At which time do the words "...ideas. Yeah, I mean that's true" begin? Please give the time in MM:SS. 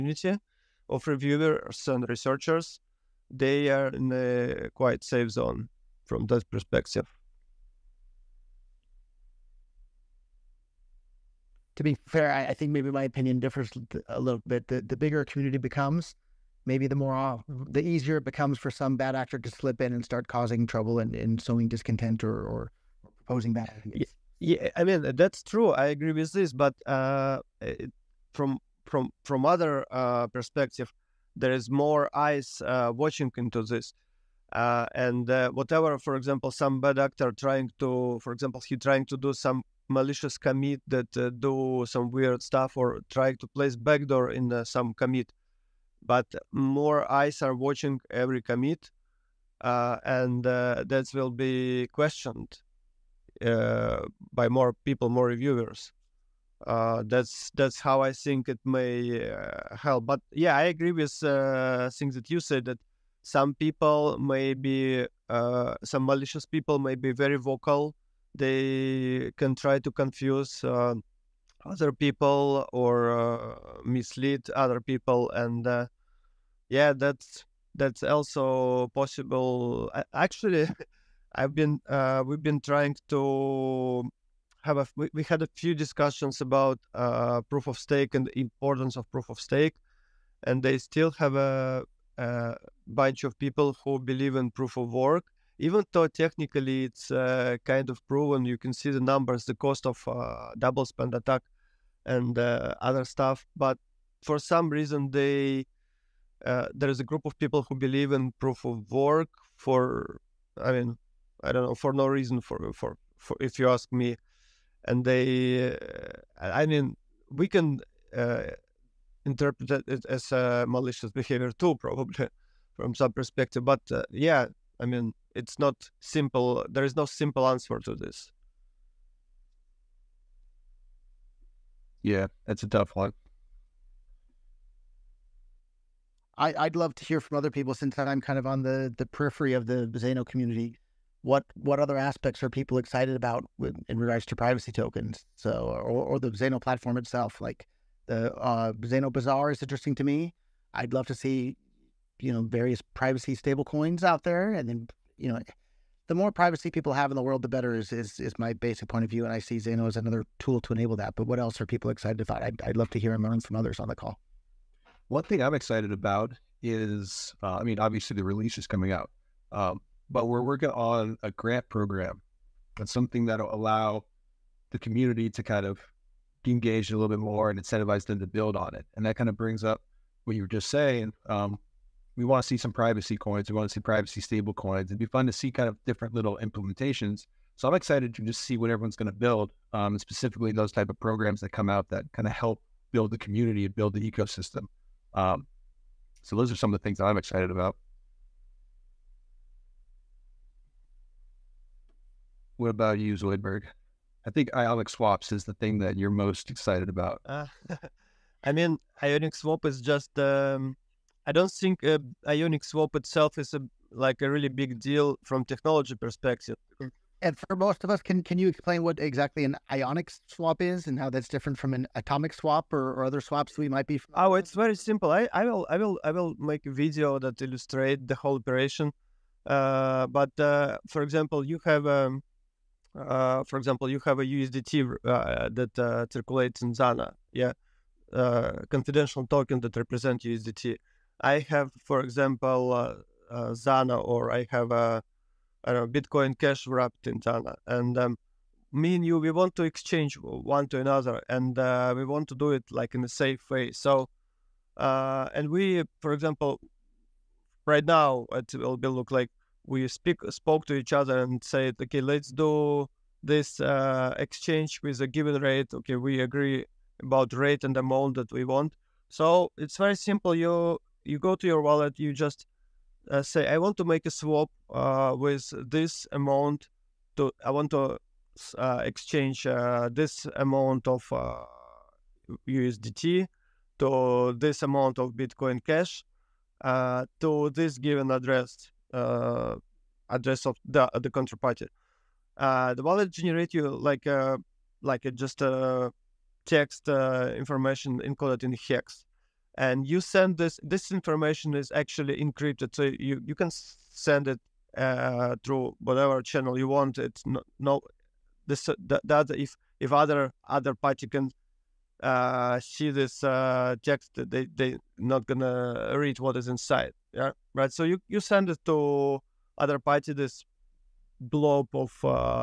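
00:23.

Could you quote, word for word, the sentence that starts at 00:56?
Uh, that's that's how I think it may uh, help.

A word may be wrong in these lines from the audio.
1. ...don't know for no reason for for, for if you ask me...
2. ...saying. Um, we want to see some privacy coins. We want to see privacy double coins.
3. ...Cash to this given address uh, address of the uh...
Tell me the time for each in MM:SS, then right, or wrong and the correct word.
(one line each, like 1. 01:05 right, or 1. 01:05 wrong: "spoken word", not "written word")
1. 01:51 right
2. 03:00 wrong: "stable", not "double"
3. 04:45 right.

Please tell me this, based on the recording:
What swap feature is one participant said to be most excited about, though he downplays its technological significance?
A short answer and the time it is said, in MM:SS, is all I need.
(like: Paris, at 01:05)
Ionic Swaps, at 03:24.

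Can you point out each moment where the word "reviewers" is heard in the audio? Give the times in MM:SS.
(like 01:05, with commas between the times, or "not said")
00:01, 00:55.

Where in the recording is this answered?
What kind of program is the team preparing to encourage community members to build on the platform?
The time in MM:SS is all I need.
02:51.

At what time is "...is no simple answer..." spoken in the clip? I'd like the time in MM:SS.
02:06.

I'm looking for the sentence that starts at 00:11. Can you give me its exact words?
To be fair, I, I think maybe my opinion differs a little bit.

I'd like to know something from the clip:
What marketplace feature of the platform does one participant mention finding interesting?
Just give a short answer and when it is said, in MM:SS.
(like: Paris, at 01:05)
Zano Bazaar, at 02:28.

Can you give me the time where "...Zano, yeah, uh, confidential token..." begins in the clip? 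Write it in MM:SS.
03:56.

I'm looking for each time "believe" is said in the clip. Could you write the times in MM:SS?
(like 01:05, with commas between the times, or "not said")
01:33, 01:47.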